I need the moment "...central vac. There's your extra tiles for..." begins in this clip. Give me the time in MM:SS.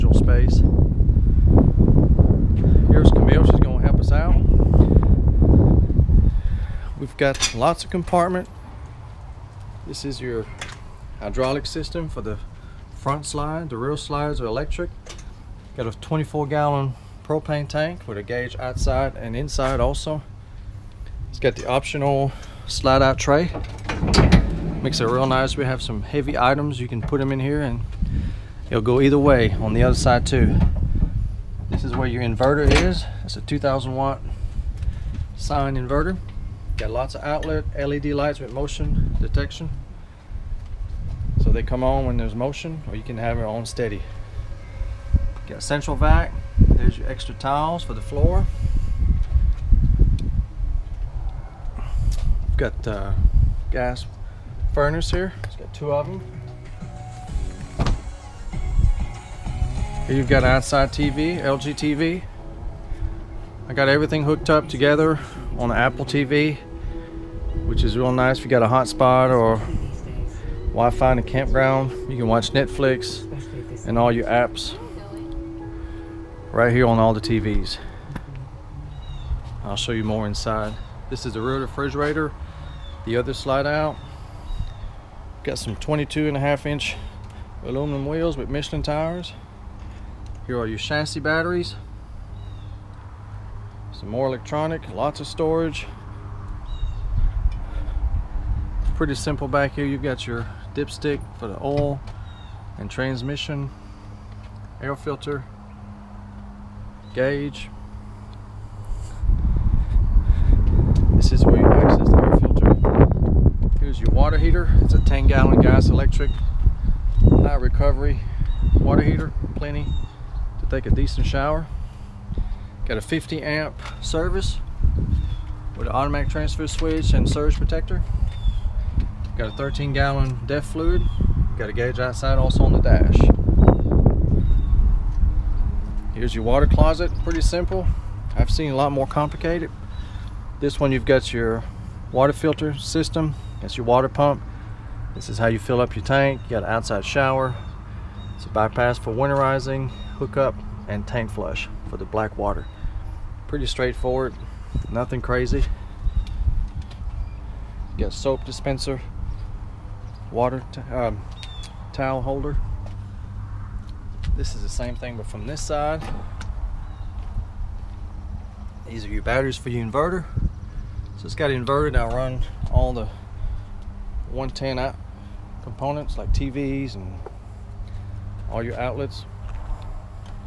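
00:45.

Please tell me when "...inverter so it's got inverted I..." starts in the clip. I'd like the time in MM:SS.
02:49.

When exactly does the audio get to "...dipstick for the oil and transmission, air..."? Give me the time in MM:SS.
01:40.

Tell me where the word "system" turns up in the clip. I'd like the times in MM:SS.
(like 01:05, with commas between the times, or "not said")
00:11, 02:22.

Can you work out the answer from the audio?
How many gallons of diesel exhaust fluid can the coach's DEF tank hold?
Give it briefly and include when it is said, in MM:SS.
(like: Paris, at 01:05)
13 gallons, at 02:09.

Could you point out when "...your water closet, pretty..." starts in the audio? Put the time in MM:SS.
02:16.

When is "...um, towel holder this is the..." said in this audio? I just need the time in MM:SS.
02:40.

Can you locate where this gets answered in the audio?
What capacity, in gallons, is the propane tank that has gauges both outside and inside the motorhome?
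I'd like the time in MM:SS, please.
00:15.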